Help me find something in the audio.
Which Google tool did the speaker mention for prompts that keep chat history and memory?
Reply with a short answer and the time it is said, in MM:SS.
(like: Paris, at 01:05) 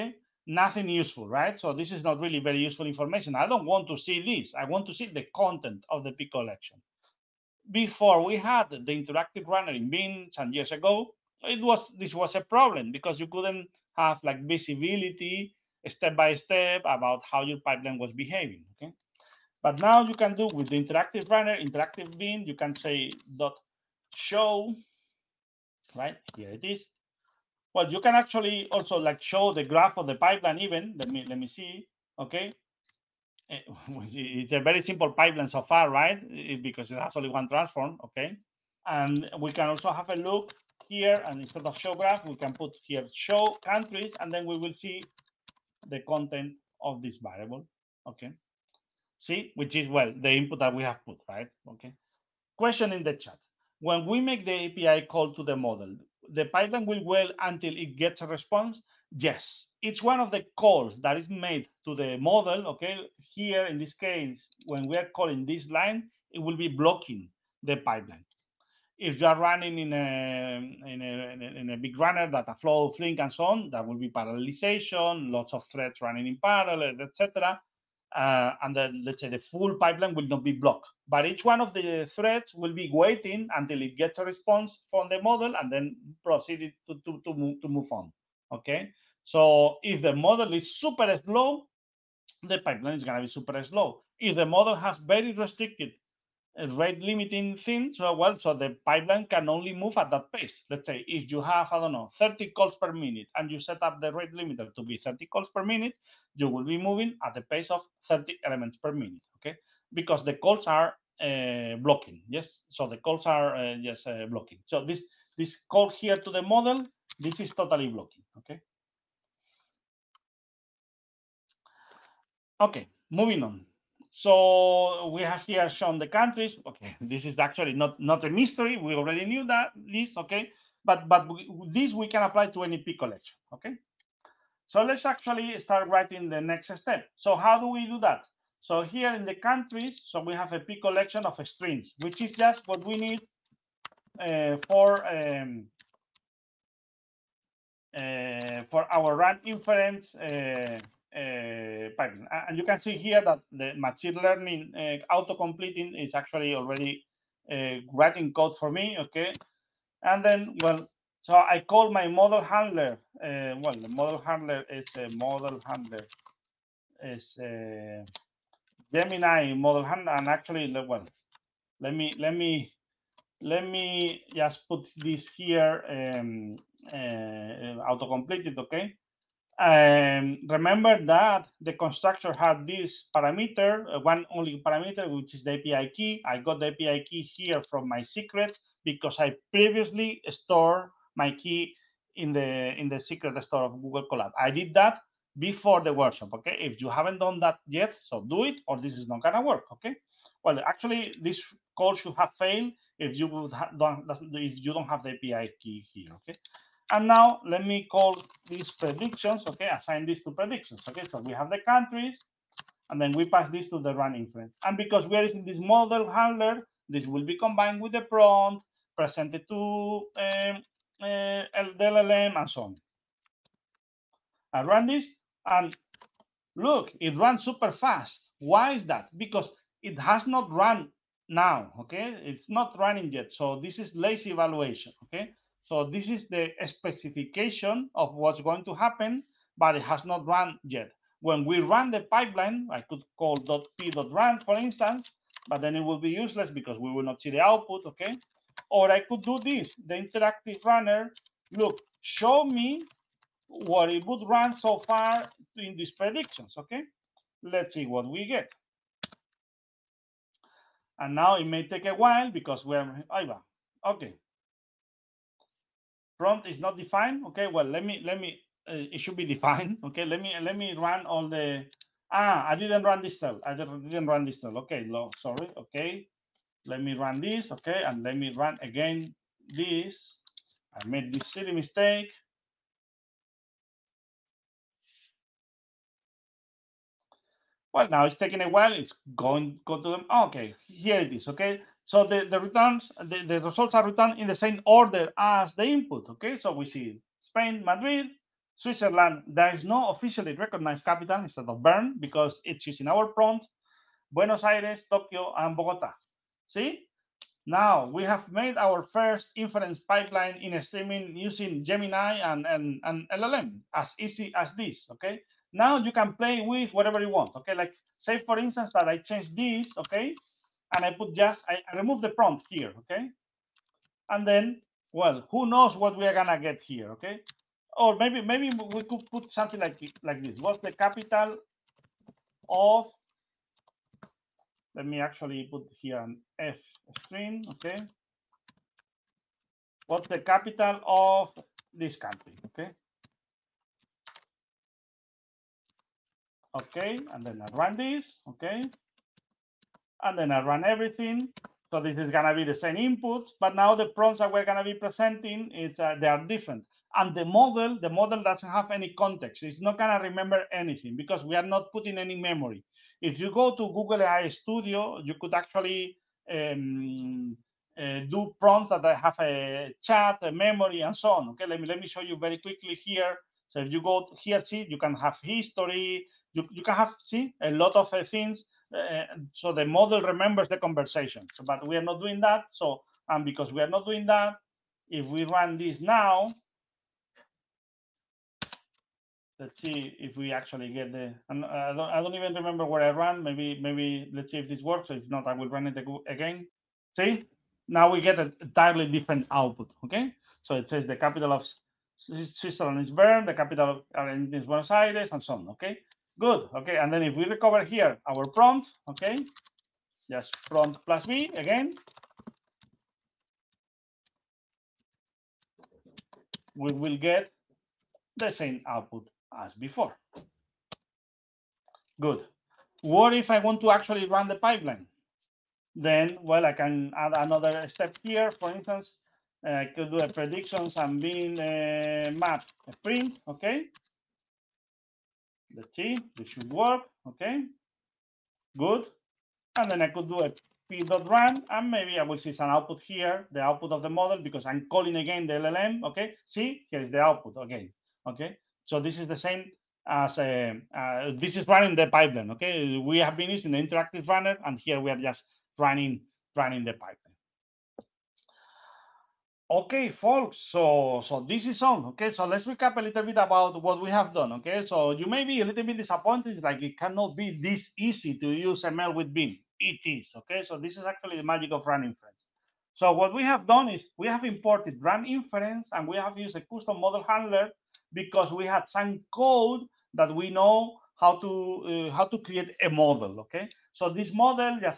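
Google AI Studio, at 06:03.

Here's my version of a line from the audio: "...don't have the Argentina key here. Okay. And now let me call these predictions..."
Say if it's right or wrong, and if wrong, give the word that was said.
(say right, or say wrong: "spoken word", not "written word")
wrong: "API", not "Argentina".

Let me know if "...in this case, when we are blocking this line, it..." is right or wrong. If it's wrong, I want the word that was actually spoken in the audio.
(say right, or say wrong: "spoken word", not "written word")
wrong: "calling", not "blocking".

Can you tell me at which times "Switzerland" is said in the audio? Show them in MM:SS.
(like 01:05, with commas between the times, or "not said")
04:58, 06:41.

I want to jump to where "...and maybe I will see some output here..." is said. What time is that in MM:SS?
07:21.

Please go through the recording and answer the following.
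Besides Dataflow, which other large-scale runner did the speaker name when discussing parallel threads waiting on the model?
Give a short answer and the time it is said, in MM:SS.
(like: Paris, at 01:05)
Flink, at 01:12.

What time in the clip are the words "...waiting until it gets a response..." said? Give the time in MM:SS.
01:22.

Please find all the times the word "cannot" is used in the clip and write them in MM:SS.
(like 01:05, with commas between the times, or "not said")
07:46.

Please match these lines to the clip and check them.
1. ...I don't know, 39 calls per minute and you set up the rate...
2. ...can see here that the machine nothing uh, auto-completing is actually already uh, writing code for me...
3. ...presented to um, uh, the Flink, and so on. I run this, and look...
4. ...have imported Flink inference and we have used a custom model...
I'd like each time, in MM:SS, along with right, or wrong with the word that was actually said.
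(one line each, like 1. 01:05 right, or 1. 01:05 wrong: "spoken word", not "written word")
1. 01:41 wrong: "30", not "39"
2. 02:32 wrong: "learning", not "nothing"
3. 03:38 wrong: "LLM", not "Flink"
4. 07:54 wrong: "Run", not "Flink".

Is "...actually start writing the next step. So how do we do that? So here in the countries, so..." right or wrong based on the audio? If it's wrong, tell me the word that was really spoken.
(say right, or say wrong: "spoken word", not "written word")
right.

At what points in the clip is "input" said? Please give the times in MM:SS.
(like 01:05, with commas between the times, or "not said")
00:50, 04:55, 05:52.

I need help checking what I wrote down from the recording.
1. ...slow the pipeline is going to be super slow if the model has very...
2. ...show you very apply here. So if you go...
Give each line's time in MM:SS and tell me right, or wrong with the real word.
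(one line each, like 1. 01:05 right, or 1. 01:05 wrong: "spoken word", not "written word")
1. 01:31 right
2. 06:11 wrong: "quickly", not "apply".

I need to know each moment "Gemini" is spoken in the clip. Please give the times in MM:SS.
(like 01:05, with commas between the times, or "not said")
02:48, 05:11.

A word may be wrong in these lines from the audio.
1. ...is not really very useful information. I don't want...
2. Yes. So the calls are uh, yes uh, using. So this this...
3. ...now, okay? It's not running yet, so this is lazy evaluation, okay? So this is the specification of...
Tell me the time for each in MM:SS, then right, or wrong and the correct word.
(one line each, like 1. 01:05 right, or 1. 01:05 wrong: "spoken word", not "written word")
1. 00:01 right
2. 01:52 wrong: "blocking", not "using"
3. 03:51 right.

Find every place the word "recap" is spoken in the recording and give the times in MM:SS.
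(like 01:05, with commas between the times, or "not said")
07:42.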